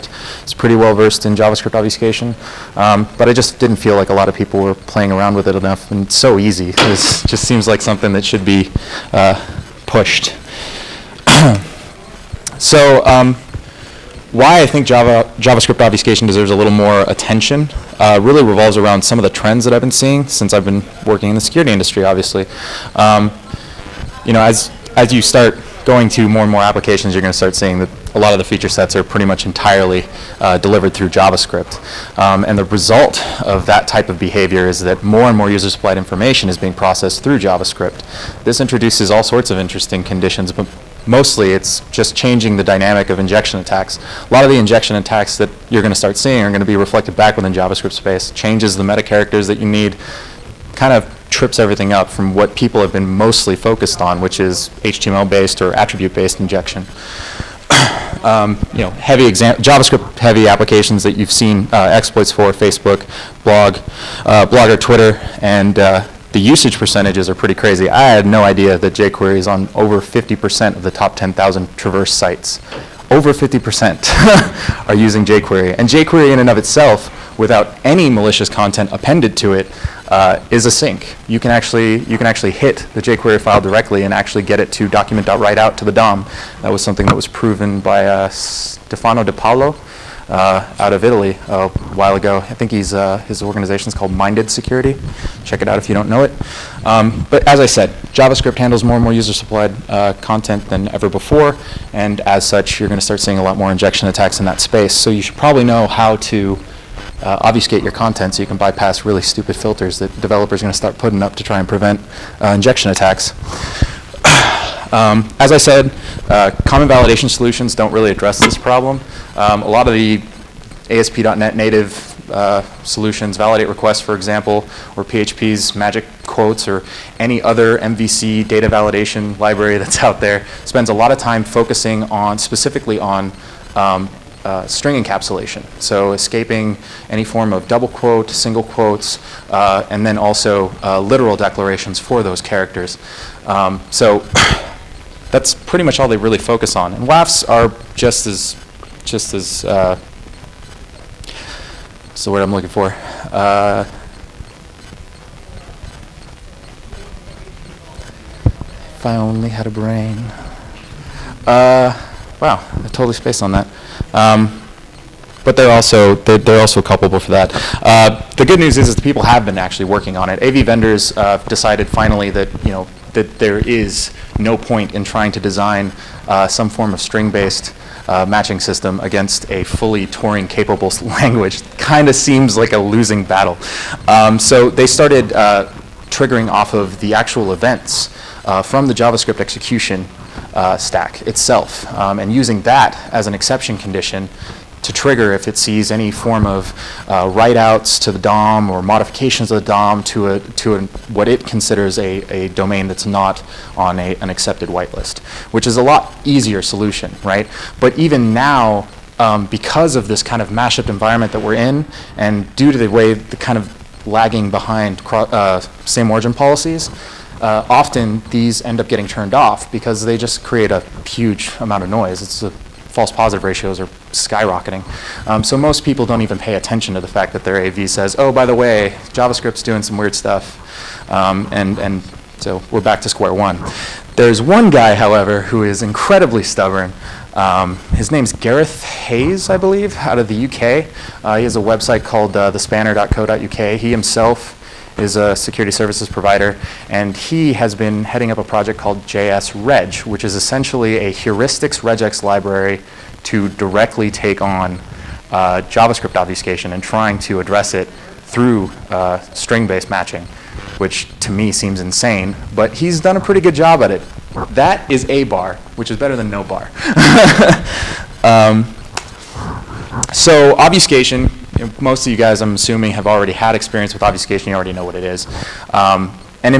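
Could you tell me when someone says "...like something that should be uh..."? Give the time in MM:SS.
00:07.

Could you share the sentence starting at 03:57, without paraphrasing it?
Um, his name's Gareth Hayes, I believe, out of the UK.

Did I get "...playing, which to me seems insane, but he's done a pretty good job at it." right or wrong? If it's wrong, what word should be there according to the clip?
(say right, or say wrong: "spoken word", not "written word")
wrong: "matching", not "playing".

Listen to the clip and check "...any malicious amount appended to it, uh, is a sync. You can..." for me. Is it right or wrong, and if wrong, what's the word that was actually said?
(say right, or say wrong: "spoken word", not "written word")
wrong: "content", not "amount".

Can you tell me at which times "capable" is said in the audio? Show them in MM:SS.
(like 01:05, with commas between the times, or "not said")
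03:00.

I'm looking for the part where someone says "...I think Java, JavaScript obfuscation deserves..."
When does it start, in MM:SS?
00:14.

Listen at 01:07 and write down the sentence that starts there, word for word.
I had no idea that jQuery is on over 50% of the top 10,000 traverse sites.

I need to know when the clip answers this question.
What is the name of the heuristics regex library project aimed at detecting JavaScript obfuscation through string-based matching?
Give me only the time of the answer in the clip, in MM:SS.
04:08.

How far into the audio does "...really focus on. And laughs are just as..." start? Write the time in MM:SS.
02:26.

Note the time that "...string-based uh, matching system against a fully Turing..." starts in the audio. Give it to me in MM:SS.
02:57.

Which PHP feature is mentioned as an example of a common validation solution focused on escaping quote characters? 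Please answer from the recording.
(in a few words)
magic quotes.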